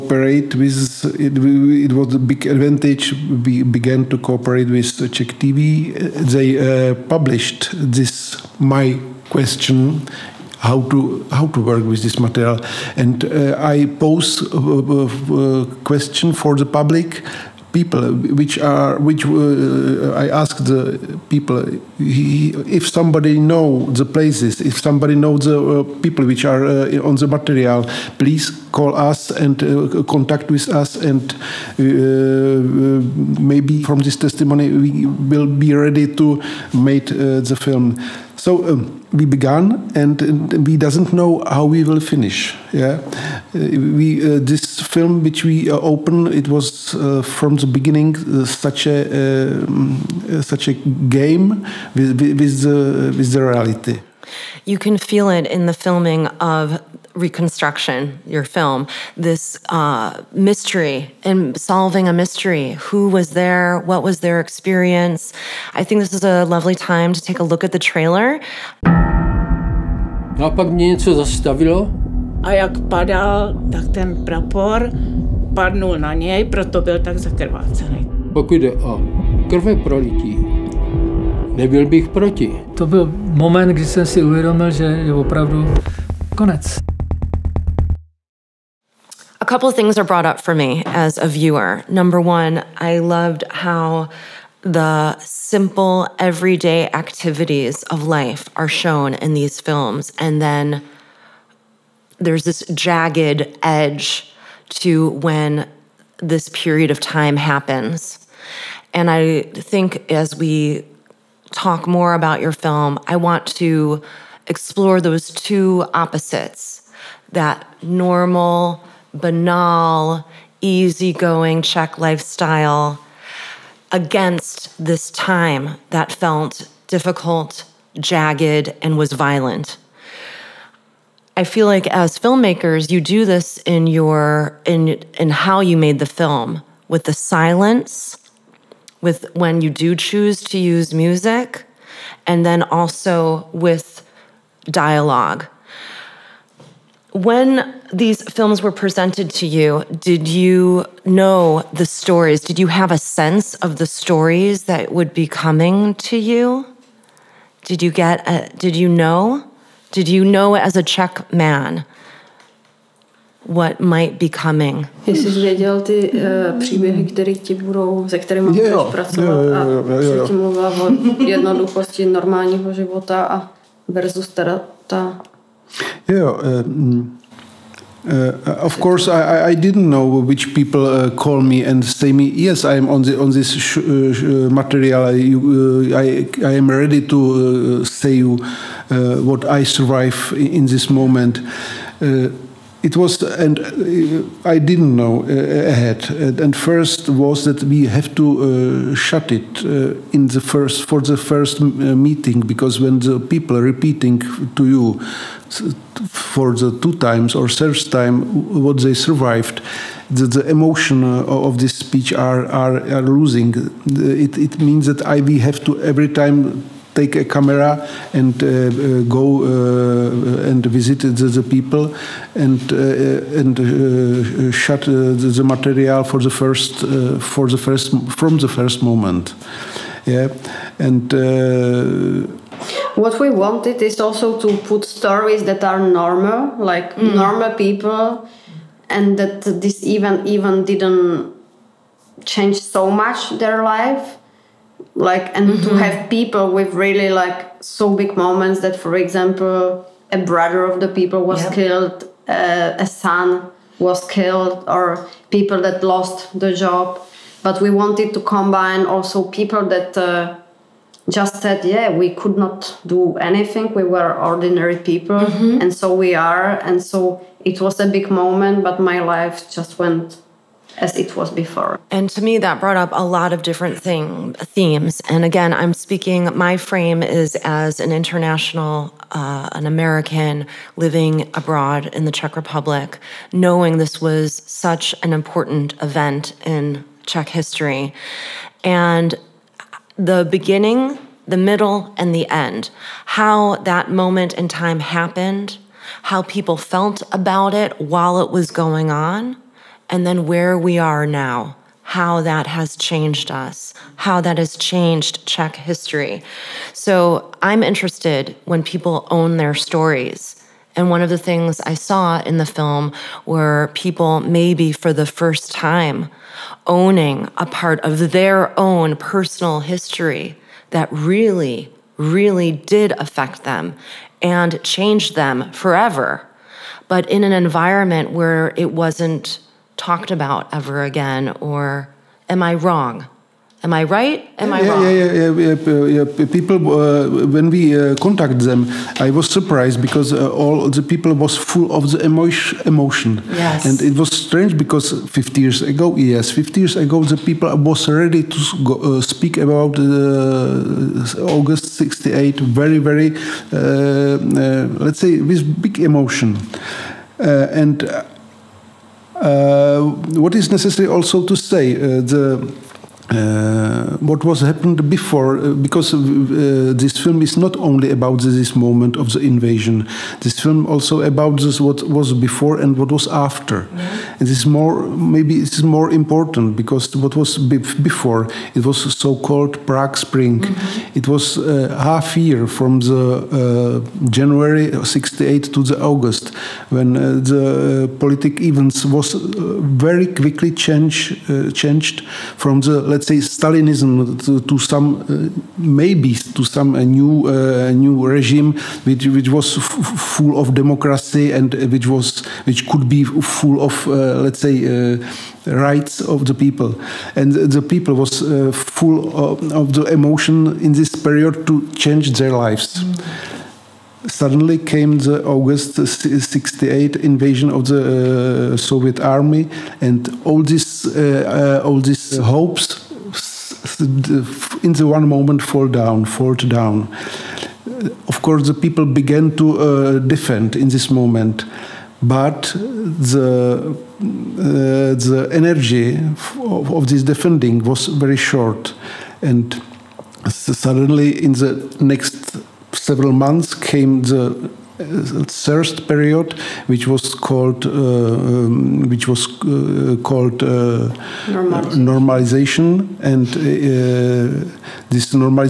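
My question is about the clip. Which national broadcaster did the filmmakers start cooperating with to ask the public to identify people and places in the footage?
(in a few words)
Czech TV.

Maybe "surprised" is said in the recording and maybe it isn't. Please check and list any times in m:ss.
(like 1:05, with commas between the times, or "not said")
5:39.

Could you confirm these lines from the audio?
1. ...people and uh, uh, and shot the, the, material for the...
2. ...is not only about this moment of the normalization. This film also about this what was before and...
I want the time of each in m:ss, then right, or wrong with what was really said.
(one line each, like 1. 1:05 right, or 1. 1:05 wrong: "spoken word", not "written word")
1. 3:41 right
2. 6:07 wrong: "invasion", not "normalization".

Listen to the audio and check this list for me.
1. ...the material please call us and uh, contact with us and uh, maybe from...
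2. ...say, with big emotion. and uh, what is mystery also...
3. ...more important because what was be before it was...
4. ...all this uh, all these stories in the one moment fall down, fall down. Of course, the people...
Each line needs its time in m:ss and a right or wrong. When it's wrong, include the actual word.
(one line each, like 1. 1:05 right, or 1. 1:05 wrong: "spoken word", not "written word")
1. 0:27 right
2. 5:54 wrong: "necessary", not "mystery"
3. 6:15 right
4. 7:00 wrong: "hopes", not "stories".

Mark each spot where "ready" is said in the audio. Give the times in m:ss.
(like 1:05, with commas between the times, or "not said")
0:35, 3:06, 5:47.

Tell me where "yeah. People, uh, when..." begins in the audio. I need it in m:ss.
5:36.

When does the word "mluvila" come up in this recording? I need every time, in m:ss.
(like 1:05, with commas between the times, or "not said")
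2:50.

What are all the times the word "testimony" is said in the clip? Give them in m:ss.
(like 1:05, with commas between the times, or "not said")
0:34.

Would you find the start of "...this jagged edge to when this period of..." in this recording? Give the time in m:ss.
1:42.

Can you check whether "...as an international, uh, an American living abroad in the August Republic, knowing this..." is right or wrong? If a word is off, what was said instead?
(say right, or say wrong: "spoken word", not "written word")
wrong: "Czech", not "August".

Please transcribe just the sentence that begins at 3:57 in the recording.
normal people and that this even even didn't change so much their life like and mm -hmm.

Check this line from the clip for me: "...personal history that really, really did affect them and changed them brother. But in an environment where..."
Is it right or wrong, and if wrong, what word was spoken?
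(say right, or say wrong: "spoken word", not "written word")
wrong: "forever", not "brother".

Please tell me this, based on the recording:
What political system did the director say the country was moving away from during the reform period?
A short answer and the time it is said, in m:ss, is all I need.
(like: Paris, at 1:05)
Stalinism, at 6:33.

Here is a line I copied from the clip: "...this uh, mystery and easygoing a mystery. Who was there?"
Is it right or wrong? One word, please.
wrong.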